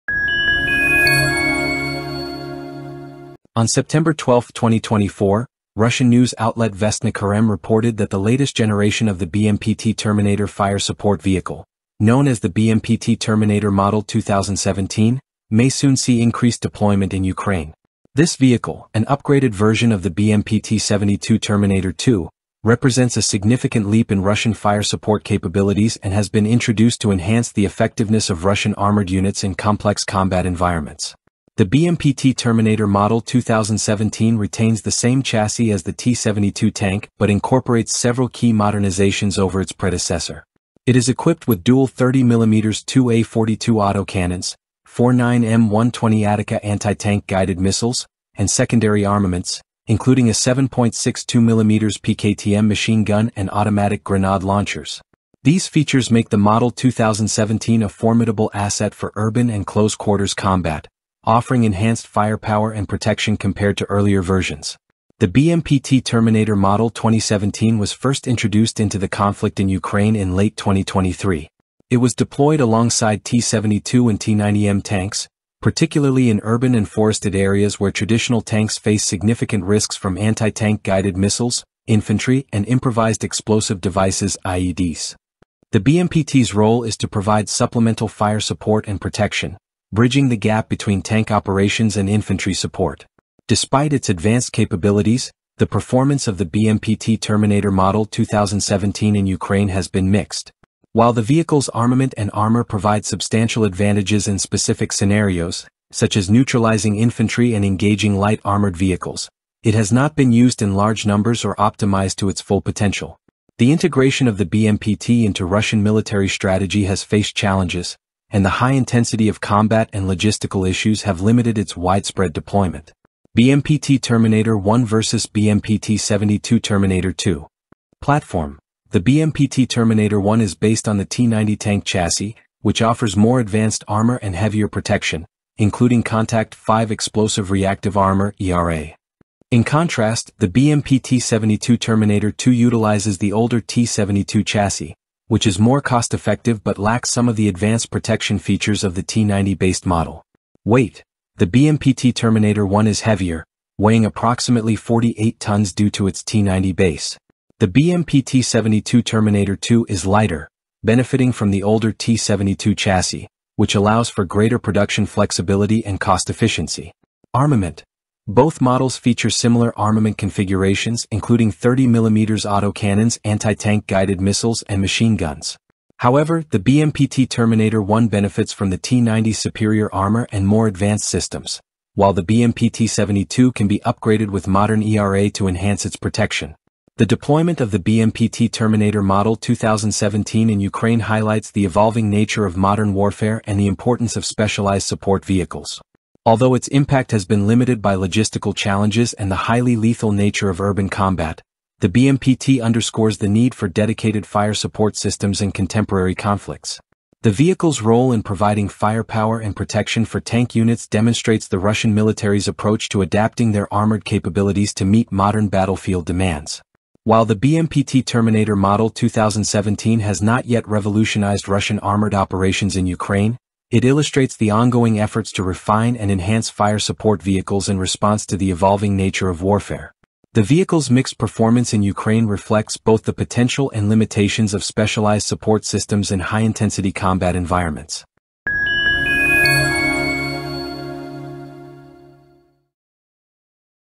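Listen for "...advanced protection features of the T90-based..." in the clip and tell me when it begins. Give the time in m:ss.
2:27.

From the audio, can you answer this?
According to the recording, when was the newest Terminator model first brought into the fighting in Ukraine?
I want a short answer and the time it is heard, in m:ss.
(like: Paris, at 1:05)
Late 2023, at 1:10.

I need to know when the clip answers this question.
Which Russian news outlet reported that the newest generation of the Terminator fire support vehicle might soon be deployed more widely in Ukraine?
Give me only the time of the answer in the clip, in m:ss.
0:06.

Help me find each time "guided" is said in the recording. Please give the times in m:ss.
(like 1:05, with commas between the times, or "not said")
0:47, 1:20, 2:53.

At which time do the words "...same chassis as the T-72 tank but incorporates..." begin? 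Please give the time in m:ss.
0:34.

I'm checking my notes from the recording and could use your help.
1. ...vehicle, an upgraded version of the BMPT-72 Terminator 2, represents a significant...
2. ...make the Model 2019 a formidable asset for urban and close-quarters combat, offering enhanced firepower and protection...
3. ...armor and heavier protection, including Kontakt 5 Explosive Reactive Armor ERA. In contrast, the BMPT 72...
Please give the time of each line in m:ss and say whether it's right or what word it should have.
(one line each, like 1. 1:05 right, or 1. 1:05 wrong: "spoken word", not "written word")
1. 0:18 right
2. 0:56 wrong: "2017", not "2019"
3. 2:13 right.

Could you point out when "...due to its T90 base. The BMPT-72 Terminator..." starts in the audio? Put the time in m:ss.
2:35.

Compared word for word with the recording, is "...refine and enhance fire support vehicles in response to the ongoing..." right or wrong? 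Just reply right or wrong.
wrong.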